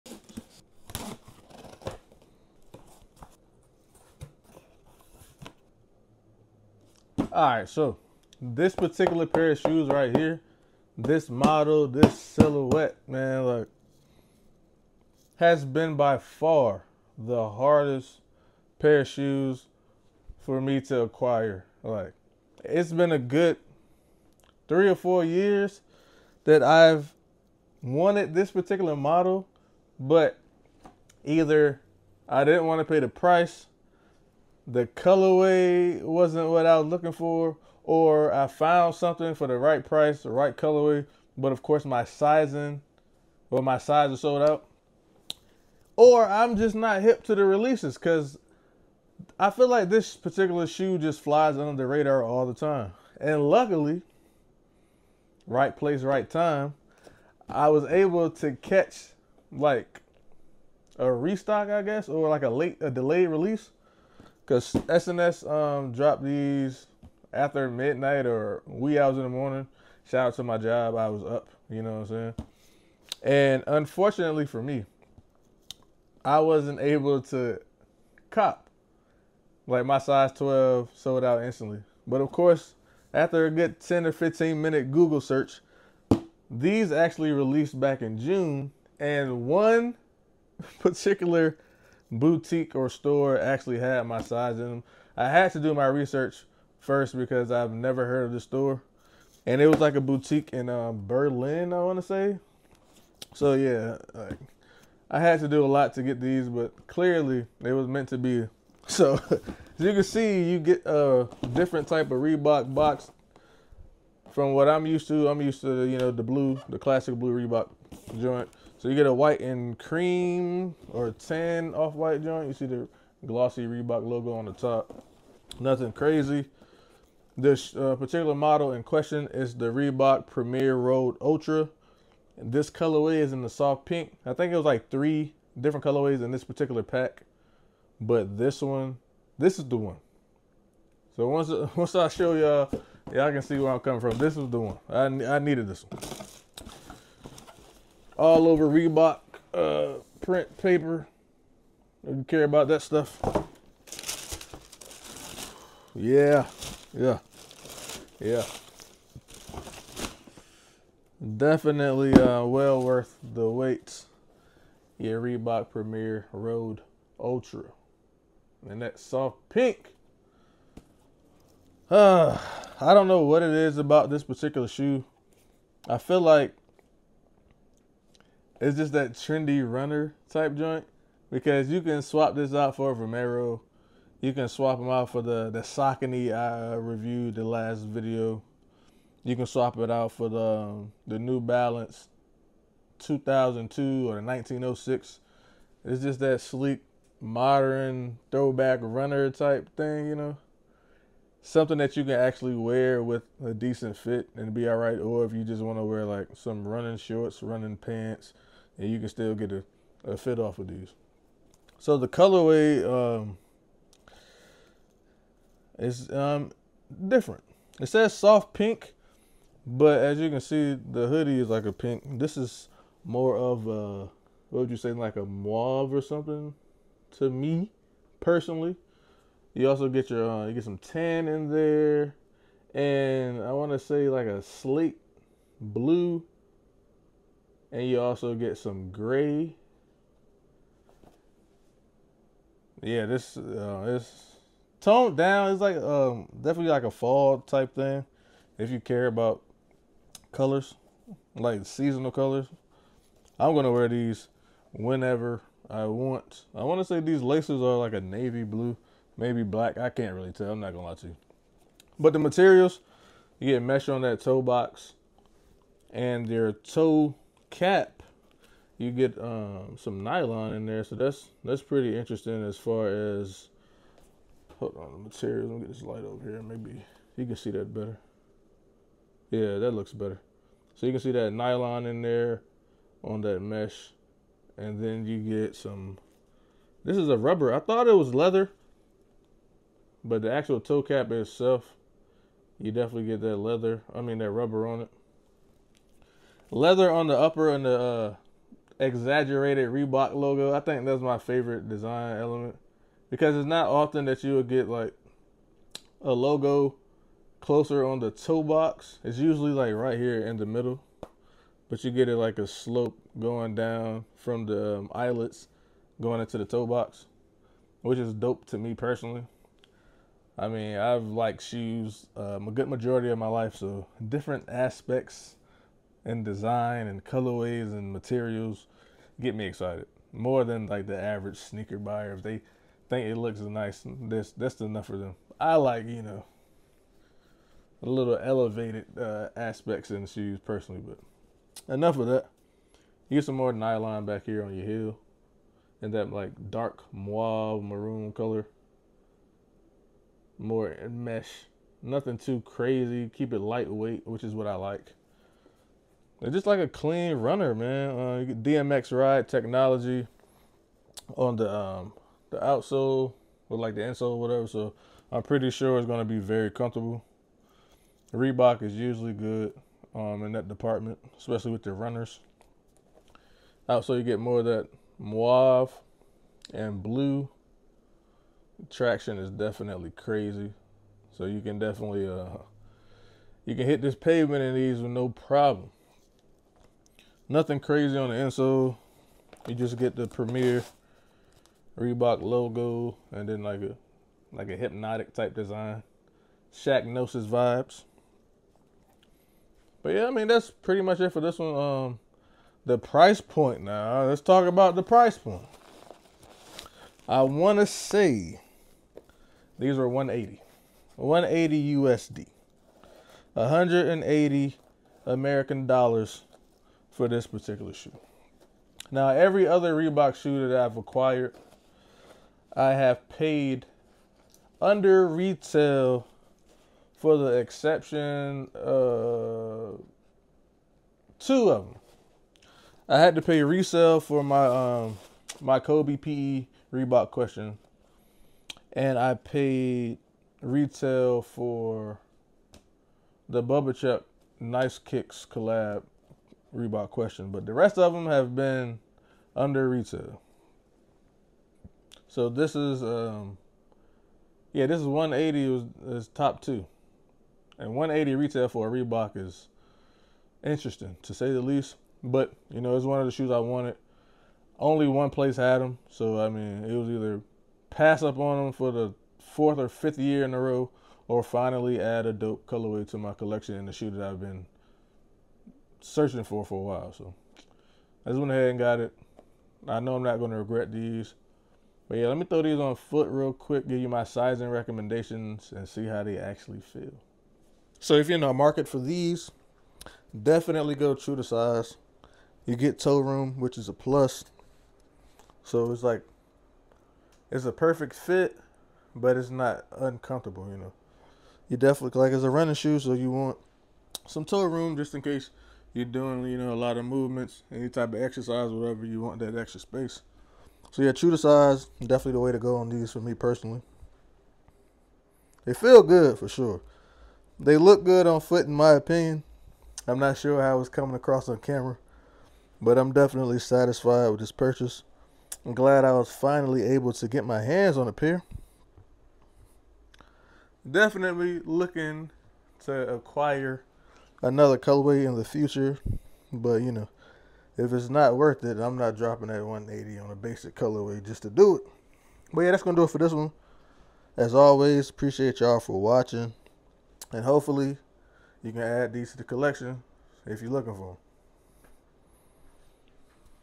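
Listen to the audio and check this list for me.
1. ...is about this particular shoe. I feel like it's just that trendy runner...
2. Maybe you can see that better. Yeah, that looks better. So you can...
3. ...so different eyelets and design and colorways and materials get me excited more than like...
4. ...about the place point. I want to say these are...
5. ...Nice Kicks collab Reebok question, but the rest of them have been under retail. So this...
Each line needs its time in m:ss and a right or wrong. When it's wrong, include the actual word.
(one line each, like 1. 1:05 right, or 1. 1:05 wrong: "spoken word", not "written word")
1. 2:53 right
2. 4:36 right
3. 5:23 wrong: "aspects", not "eyelets"
4. 6:44 wrong: "price", not "place"
5. 7:24 right.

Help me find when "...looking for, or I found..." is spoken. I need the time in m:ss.
0:36.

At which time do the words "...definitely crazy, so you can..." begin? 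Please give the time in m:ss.
6:19.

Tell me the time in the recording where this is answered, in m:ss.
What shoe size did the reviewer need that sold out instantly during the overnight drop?
1:19.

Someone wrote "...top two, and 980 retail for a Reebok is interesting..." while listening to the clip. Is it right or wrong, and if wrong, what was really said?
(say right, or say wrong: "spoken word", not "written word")
wrong: "180", not "980".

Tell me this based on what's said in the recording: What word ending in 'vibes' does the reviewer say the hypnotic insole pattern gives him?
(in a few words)
Shaqnosis.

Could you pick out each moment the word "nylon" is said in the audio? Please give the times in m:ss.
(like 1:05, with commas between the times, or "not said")
4:30, 4:41, 5:43.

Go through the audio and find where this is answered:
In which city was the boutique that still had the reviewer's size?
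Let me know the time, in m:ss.
1:41.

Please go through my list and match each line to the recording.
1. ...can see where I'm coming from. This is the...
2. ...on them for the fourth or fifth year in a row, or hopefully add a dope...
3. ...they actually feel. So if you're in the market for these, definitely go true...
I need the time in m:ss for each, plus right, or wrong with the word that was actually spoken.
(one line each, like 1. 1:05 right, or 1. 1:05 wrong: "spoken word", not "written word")
1. 2:23 right
2. 7:48 wrong: "finally", not "hopefully"
3. 8:06 right.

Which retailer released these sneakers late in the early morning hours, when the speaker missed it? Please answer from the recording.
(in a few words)
SNS.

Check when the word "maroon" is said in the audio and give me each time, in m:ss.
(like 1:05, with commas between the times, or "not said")
5:47.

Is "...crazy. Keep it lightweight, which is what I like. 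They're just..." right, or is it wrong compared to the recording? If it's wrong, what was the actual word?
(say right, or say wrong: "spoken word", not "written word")
right.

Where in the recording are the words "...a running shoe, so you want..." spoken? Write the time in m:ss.
8:22.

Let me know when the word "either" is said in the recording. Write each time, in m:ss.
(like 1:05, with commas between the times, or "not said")
0:31, 7:46.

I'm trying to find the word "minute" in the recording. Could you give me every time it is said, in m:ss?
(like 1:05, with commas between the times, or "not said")
1:24.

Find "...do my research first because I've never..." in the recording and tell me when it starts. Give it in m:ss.
1:35.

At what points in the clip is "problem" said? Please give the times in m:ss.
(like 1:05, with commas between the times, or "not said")
6:25.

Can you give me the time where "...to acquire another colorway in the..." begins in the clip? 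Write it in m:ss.
8:52.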